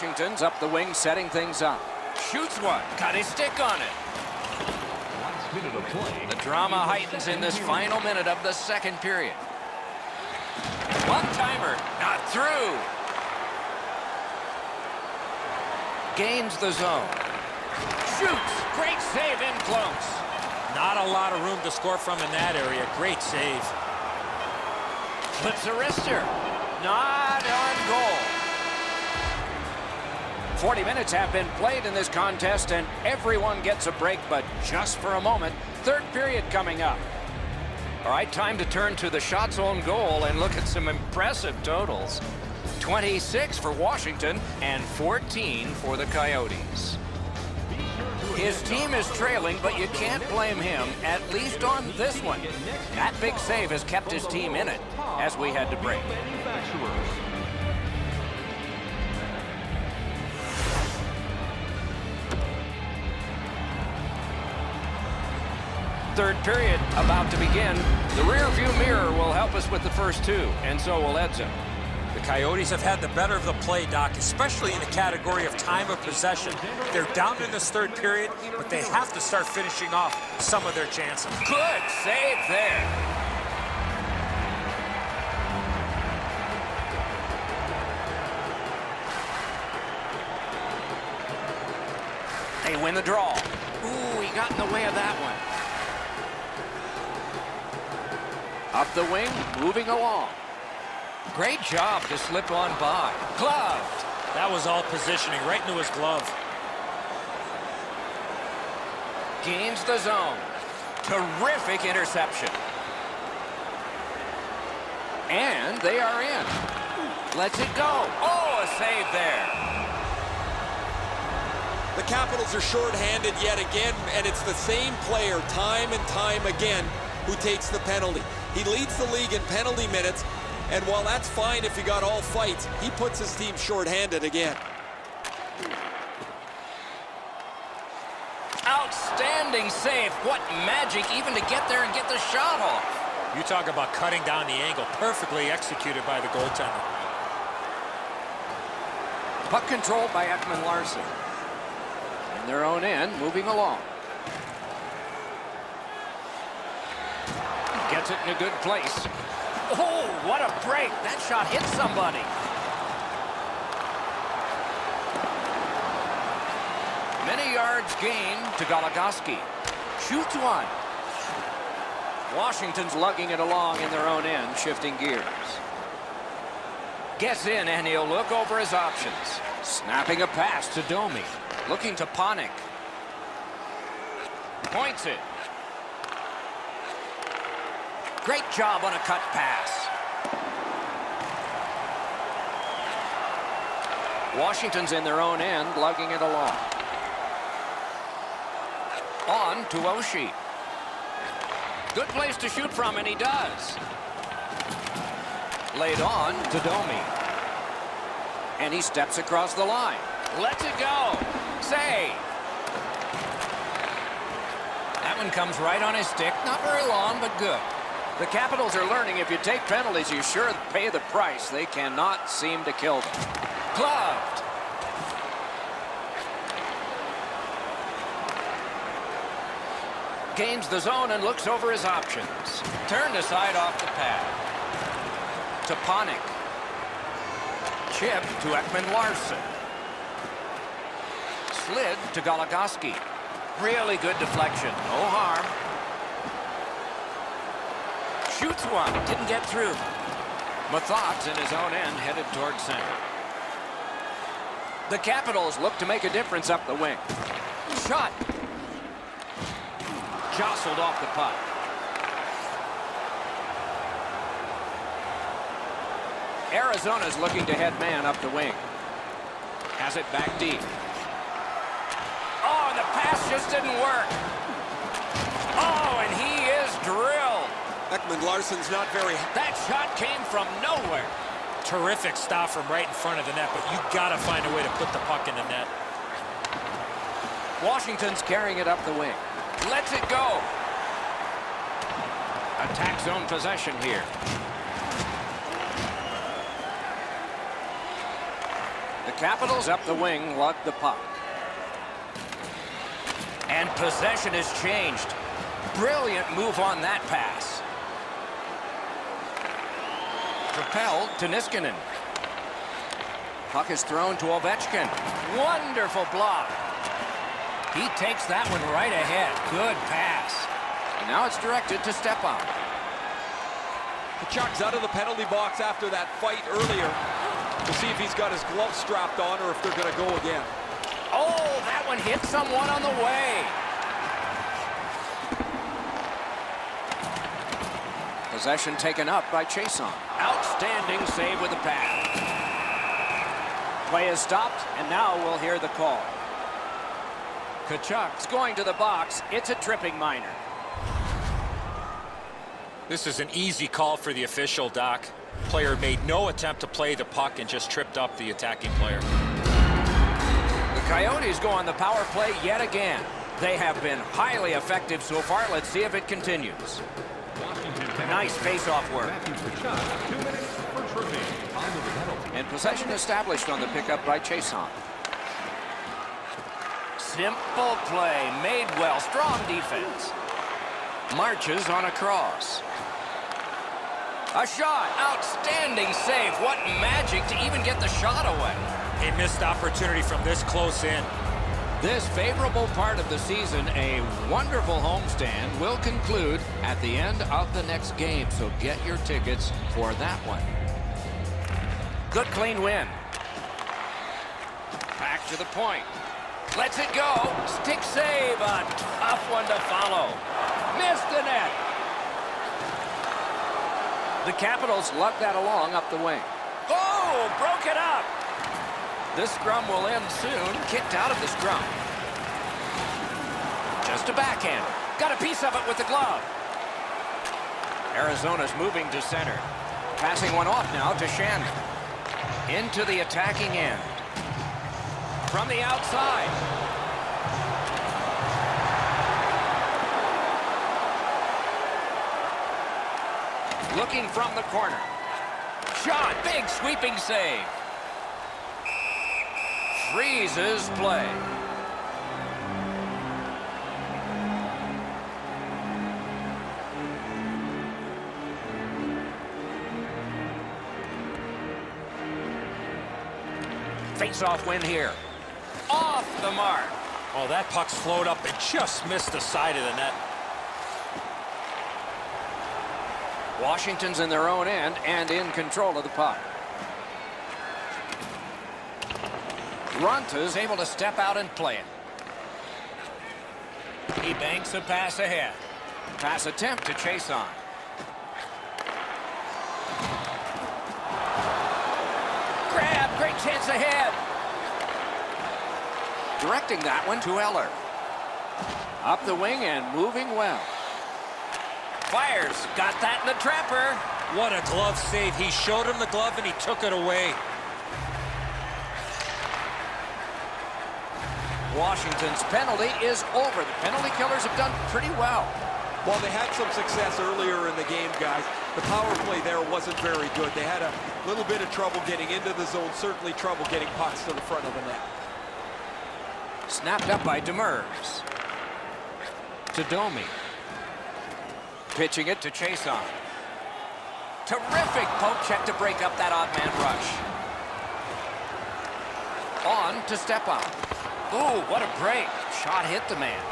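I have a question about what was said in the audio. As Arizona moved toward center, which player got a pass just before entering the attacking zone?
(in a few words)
Shannon.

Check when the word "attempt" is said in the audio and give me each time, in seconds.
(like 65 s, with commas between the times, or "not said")
356 s, 486 s.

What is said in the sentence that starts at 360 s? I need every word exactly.
The Coyotes go on the power play yet again.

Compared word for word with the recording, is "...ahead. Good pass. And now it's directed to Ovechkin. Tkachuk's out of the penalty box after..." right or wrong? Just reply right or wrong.
wrong.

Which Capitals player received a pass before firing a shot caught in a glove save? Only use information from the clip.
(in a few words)
Eller.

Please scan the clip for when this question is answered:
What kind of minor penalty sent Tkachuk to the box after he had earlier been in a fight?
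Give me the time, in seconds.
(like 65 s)
349 s.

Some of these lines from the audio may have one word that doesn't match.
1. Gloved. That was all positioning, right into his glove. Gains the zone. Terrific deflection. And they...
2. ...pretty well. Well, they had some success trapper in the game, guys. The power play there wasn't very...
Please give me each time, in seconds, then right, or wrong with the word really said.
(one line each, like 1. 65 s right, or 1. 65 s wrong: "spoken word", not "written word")
1. 103 s wrong: "interception", not "deflection"
2. 514 s wrong: "earlier", not "trapper".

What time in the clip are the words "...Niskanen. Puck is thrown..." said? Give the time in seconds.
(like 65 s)
311 s.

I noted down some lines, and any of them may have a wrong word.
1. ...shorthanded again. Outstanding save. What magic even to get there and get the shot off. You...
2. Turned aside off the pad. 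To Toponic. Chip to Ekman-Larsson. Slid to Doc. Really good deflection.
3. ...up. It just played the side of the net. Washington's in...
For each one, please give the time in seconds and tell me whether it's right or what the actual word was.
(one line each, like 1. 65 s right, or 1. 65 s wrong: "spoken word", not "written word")
1. 133 s right
2. 232 s wrong: "Goligoski", not "Doc"
3. 468 s wrong: "missed", not "played".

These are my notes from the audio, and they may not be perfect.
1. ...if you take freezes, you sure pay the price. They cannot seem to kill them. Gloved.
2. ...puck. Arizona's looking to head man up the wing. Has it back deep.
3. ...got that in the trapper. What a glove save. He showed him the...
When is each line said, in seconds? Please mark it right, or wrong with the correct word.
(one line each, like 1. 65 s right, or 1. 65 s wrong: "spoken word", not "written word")
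1. 219 s wrong: "penalties", not "freezes"
2. 261 s right
3. 502 s right.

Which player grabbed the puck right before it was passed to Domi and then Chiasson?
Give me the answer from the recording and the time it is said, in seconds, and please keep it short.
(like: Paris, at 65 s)
Demers, at 527 s.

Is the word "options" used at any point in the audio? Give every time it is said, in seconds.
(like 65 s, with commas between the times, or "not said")
178 s, 231 s.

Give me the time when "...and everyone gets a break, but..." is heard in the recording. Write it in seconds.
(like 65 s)
32 s.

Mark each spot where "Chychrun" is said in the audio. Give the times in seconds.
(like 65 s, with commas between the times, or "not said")
339 s, 374 s.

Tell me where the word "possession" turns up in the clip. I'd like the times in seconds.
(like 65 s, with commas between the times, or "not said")
76 s, 293 s, 303 s, 338 s, 372 s.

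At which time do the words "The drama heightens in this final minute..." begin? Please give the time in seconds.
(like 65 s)
6 s.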